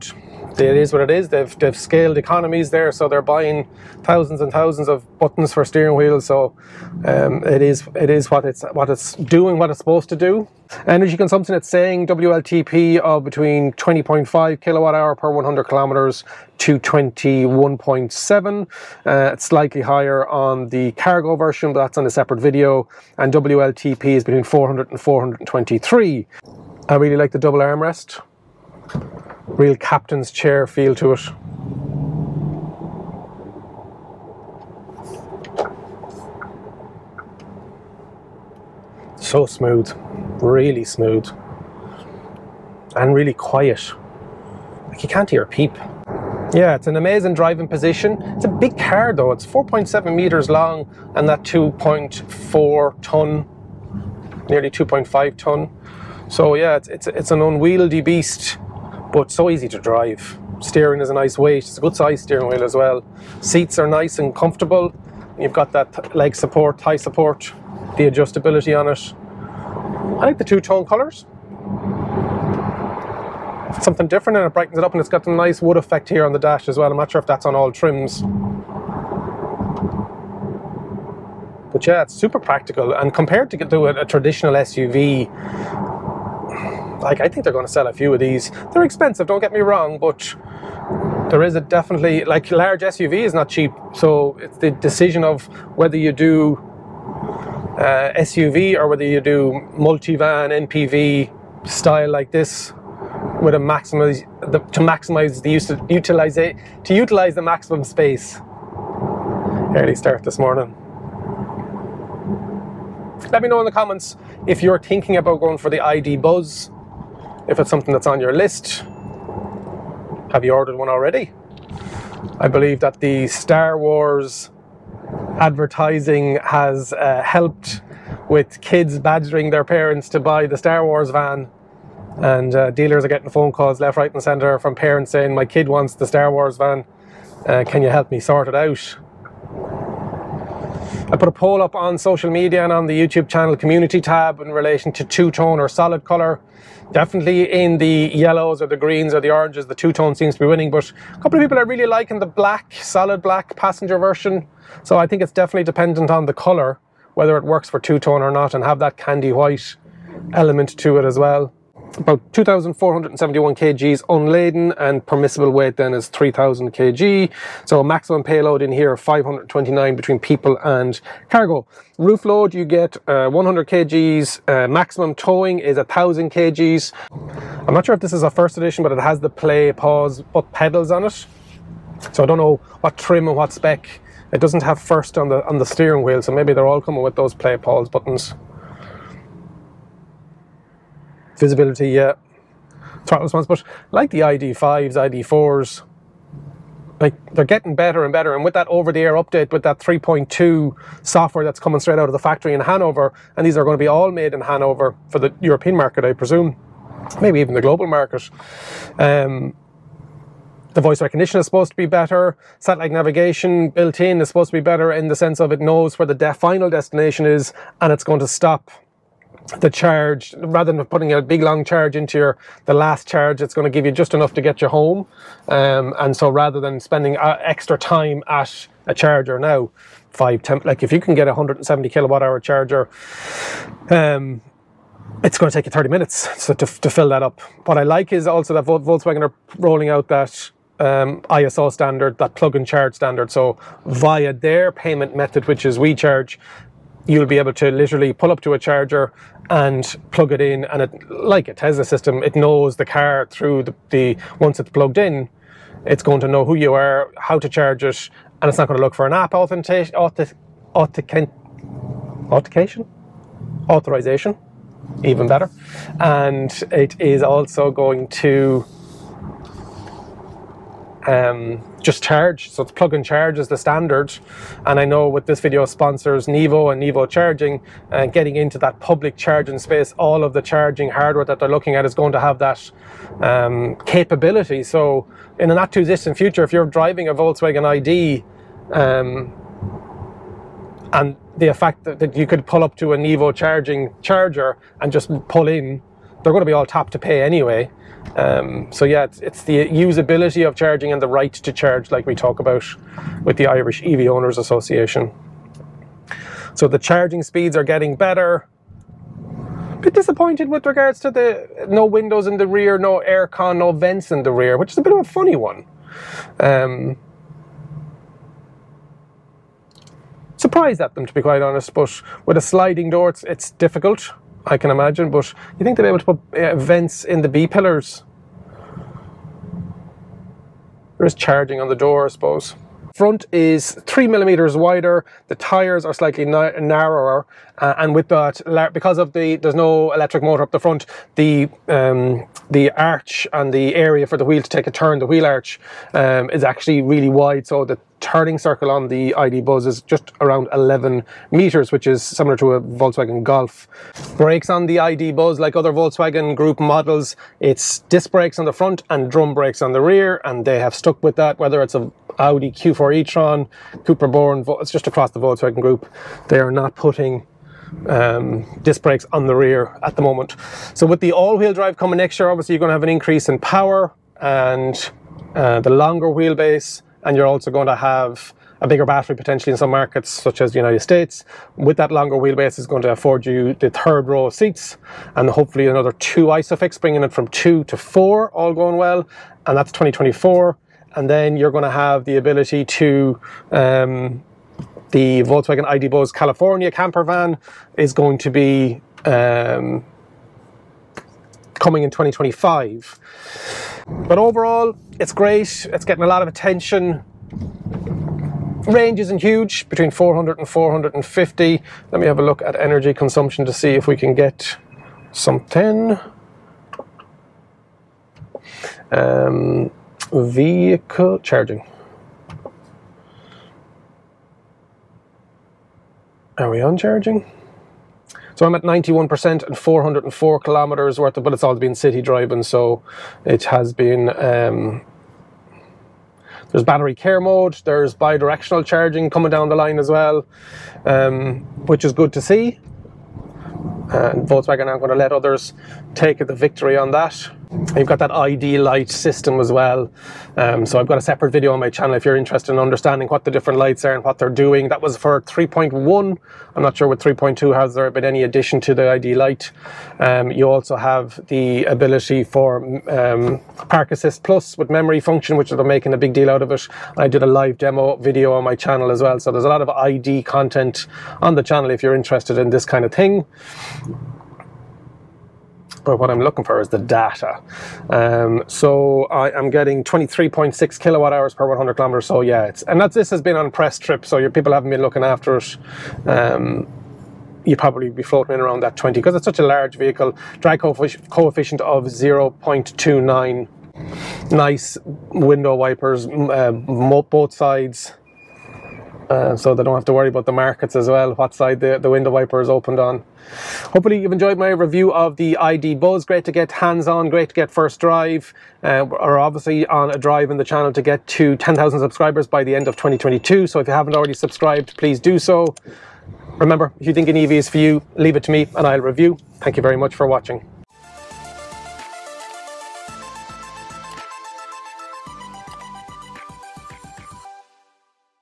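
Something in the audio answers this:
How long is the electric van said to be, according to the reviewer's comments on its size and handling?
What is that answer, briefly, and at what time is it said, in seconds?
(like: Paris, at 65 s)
4.7 meters, at 49 s.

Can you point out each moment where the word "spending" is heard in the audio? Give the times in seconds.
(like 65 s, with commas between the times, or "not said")
226 s.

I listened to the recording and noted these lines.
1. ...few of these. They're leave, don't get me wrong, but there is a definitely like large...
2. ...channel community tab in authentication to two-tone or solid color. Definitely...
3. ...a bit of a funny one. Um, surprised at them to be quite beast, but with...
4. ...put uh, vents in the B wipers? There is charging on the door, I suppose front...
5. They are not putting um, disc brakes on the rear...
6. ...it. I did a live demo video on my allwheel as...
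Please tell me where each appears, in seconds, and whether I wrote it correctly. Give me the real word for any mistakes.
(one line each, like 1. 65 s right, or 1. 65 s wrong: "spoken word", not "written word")
1. 87 s wrong: "expensive", not "leave"
2. 143 s wrong: "relation", not "authentication"
3. 314 s wrong: "honest", not "beast"
4. 326 s wrong: "pillars", not "wipers"
5. 366 s right
6. 466 s wrong: "channel", not "allwheel".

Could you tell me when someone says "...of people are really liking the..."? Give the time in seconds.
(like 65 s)
151 s.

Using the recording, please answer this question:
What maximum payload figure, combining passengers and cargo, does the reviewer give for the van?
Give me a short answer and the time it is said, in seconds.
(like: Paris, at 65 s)
529, at 168 s.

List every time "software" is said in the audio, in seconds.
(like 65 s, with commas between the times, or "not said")
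201 s.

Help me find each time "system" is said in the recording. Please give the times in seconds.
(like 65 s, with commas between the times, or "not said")
251 s, 448 s.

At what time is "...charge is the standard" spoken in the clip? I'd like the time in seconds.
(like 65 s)
273 s.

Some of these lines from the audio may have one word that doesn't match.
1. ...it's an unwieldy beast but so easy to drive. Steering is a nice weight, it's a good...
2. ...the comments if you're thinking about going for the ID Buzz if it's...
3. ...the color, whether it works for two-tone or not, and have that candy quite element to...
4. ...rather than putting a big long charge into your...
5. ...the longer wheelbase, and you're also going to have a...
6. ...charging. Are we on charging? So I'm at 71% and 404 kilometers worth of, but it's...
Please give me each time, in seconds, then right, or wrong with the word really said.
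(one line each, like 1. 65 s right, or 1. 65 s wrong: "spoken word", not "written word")
1. 57 s right
2. 113 s right
3. 156 s wrong: "white", not "quite"
4. 220 s right
5. 375 s right
6. 421 s wrong: "91", not "71".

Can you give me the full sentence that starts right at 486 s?
Um, you probably be floating in around that 20 because it's such a large vehicle.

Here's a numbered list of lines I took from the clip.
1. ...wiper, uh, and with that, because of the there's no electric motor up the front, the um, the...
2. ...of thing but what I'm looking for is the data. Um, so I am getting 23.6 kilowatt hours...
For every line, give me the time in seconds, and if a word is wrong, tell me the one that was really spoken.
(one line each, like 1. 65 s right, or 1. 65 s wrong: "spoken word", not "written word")
1. 336 s wrong: "narrower", not "wiper"
2. 472 s right.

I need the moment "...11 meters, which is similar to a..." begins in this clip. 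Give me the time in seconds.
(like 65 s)
350 s.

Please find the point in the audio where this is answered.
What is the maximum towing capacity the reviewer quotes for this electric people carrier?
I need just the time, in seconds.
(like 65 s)
175 s.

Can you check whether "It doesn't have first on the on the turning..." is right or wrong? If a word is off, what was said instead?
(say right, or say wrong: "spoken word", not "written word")
wrong: "steering", not "turning".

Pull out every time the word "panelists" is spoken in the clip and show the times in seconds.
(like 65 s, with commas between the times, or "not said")
not said.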